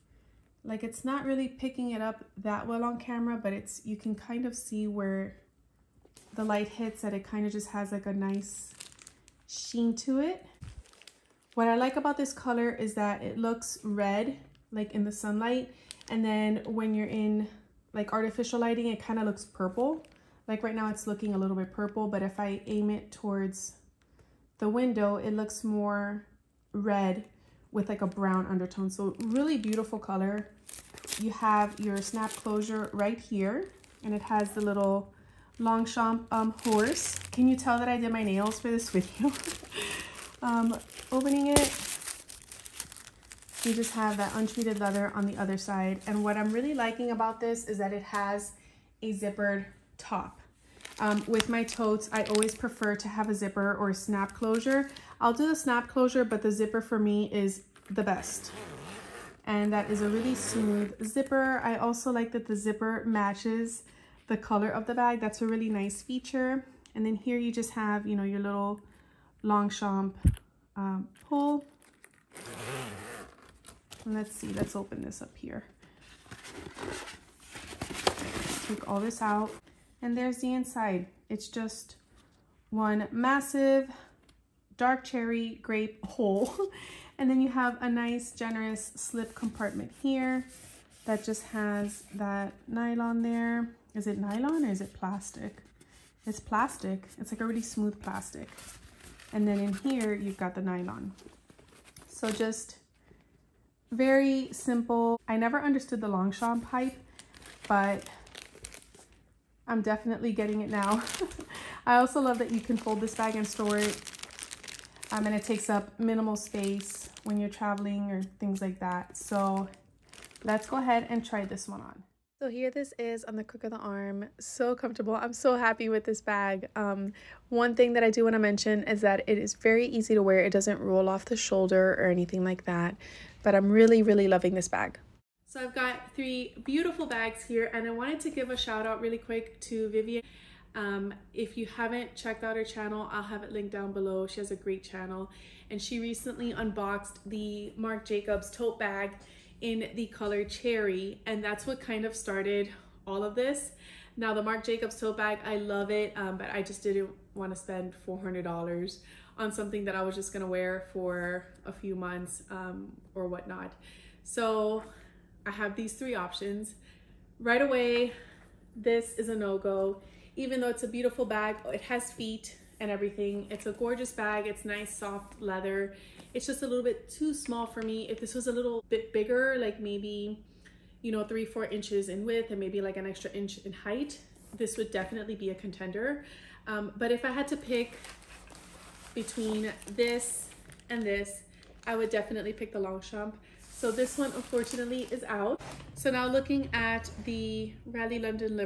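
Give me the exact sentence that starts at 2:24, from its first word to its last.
She has a great channel and she recently unboxed the Marc Jacobs tote bag in the color cherry.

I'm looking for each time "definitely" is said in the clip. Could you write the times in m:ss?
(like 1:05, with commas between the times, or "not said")
1:49, 3:04, 3:12.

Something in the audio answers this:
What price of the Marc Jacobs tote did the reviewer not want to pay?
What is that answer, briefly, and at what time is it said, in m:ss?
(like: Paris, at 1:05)
$400, at 2:38.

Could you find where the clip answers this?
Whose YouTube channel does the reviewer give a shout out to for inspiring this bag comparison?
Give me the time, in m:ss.
2:19.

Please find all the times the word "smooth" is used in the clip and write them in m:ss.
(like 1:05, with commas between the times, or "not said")
1:00, 1:37.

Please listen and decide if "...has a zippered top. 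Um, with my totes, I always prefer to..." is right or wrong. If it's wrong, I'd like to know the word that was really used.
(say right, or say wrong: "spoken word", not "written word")
right.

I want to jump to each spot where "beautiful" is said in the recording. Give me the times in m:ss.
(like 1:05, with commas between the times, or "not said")
0:29, 2:16, 2:50.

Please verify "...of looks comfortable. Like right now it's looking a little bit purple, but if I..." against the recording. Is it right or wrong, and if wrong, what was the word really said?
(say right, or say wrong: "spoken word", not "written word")
wrong: "purple", not "comfortable".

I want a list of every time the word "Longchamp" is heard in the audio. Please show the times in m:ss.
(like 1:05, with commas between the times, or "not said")
0:35, 1:09, 1:46, 3:12.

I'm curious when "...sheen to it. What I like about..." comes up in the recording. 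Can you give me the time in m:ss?
0:09.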